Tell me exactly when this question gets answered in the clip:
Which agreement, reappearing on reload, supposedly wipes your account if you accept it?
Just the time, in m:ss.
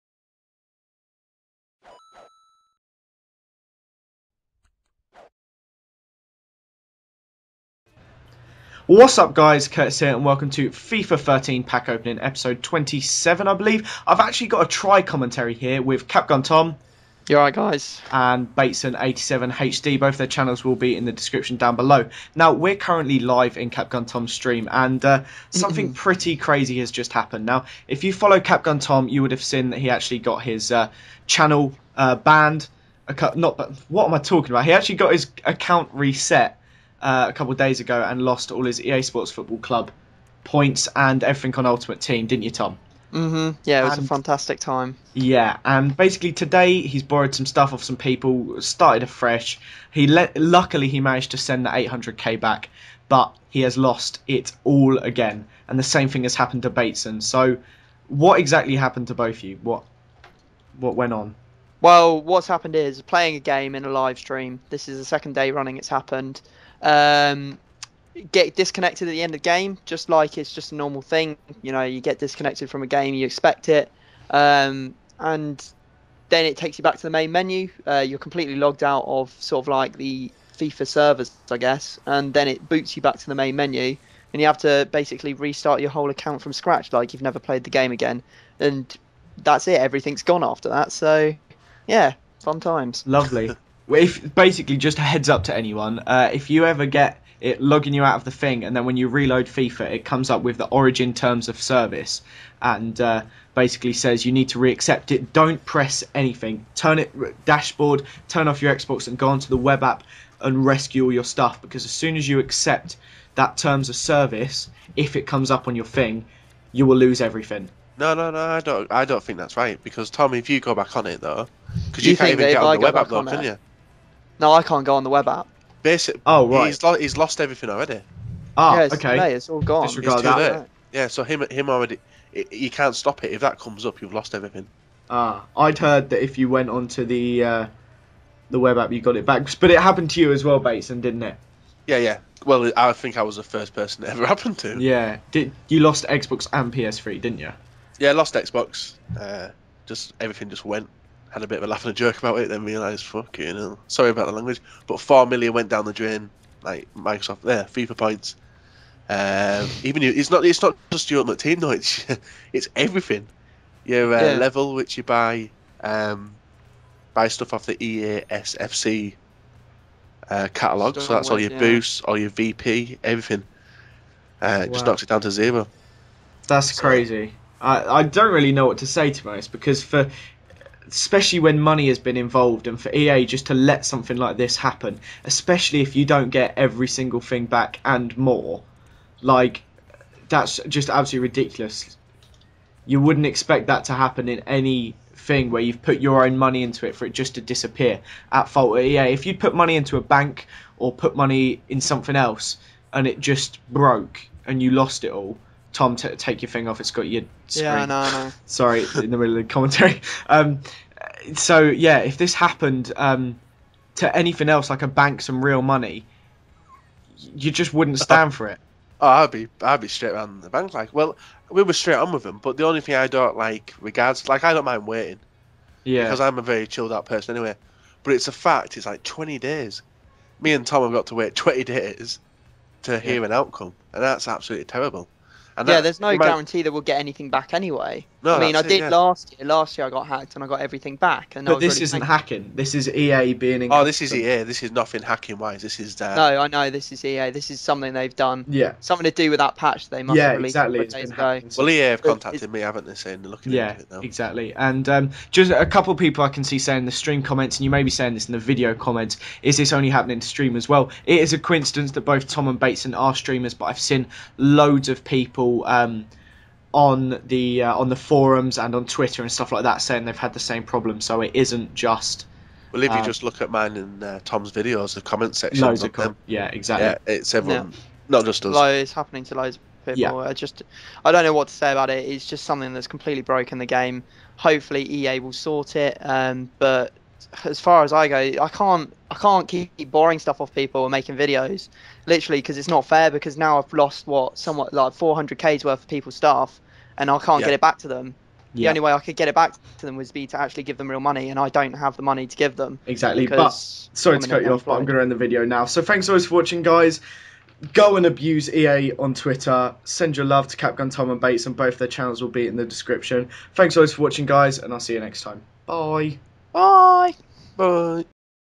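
1:40.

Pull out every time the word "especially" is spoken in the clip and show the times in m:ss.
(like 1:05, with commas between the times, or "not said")
3:00, 3:05.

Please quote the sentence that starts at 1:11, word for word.
You know, you get disconnected from a game, you expect it, um, and then it takes you back to the main menu.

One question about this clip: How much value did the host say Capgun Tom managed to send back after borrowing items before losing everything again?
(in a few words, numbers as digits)
800k.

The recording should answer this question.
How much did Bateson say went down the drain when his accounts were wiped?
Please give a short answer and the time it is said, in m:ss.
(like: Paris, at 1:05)
four million, at 2:34.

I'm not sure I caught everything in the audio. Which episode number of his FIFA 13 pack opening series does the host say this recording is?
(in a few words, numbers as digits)
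27.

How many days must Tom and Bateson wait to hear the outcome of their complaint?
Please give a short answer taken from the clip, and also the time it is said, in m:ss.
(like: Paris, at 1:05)
20, at 3:49.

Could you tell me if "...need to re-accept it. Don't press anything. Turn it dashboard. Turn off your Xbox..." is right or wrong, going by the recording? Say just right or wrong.
right.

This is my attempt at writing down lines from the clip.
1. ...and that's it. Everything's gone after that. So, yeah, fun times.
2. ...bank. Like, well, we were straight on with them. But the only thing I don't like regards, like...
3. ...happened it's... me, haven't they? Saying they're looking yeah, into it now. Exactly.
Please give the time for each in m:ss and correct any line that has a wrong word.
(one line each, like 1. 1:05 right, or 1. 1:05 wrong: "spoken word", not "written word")
1. 1:28 right
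2. 3:40 right
3. 4:12 wrong: "contacted", not "happened".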